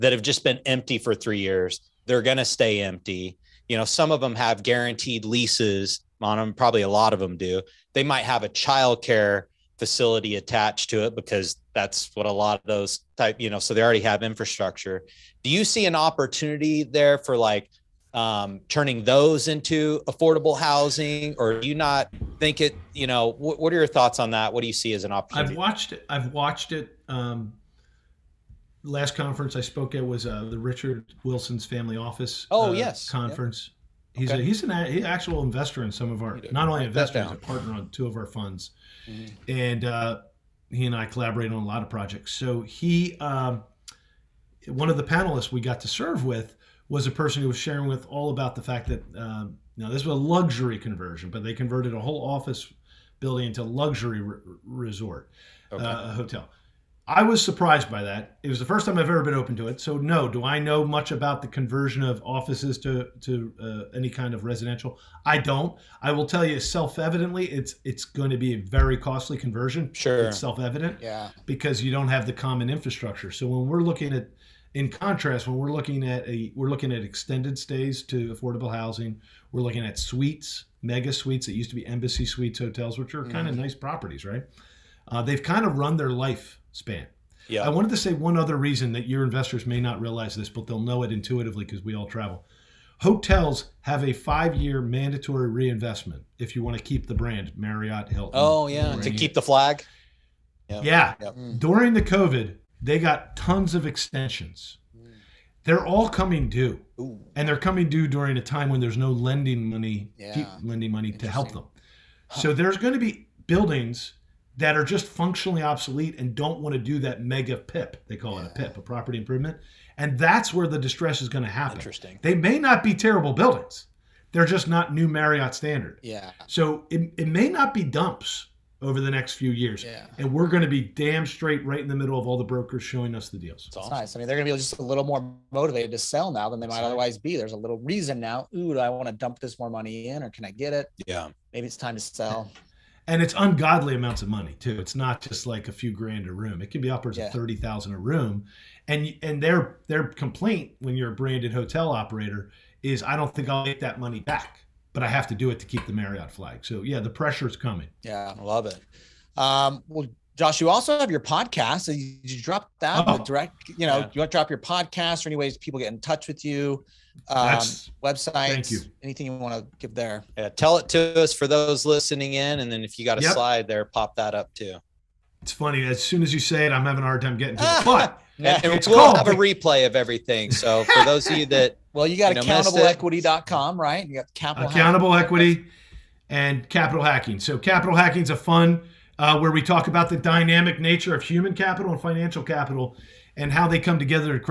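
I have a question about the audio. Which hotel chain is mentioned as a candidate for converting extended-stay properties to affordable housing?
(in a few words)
Embassy Suites.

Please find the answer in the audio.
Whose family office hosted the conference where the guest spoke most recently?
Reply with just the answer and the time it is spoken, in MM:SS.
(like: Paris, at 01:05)
Richard Wilson, at 00:30.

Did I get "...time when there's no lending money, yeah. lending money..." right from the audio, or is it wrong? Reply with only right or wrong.
right.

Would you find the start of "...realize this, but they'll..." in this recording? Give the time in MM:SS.
01:30.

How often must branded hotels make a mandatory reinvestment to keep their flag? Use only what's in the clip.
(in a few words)
every 5 years.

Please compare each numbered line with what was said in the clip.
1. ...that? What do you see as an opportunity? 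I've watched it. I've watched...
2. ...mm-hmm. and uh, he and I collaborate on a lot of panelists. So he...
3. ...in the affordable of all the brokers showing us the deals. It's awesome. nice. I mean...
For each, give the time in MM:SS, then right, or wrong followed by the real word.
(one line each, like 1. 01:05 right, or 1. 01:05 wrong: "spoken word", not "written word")
1. 00:24 right
2. 00:39 wrong: "projects", not "panelists"
3. 02:11 wrong: "middle", not "affordable".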